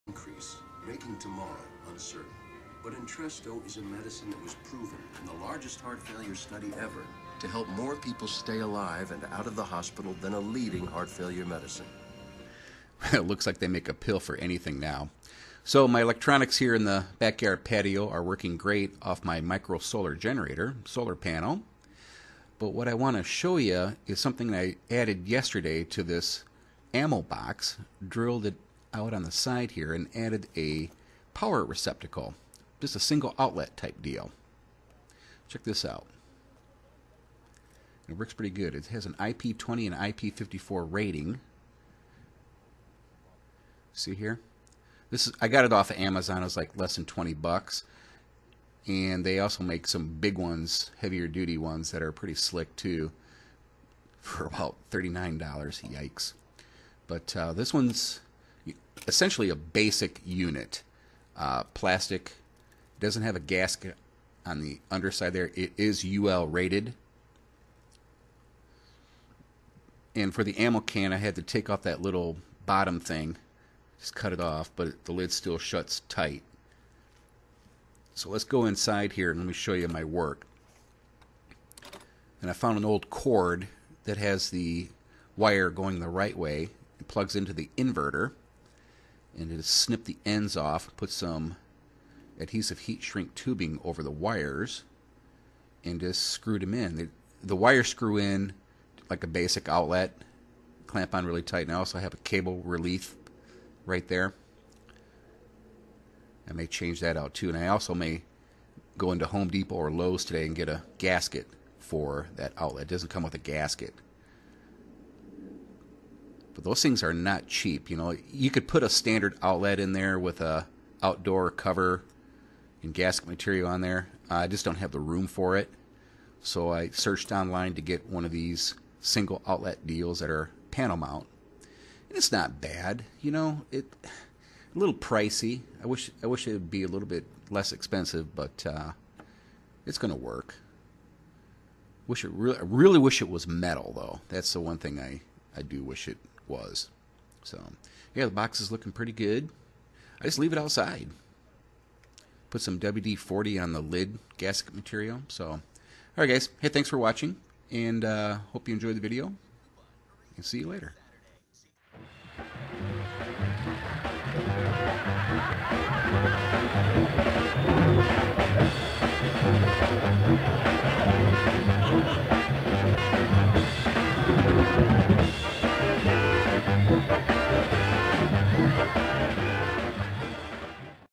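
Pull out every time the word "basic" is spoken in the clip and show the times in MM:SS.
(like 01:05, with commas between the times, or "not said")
00:59, 01:39.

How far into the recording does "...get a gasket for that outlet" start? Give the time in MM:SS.
01:50.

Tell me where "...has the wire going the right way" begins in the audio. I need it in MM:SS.
01:24.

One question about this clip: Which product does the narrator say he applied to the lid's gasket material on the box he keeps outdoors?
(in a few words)
WD-40.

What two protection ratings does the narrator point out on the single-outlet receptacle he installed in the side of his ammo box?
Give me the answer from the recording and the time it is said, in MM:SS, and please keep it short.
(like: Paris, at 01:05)
IP20 and IP54, at 00:39.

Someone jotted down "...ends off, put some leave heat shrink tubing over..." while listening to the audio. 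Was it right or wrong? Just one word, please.
wrong.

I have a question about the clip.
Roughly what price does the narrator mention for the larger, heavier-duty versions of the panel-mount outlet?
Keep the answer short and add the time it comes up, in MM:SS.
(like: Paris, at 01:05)
$39, at 00:54.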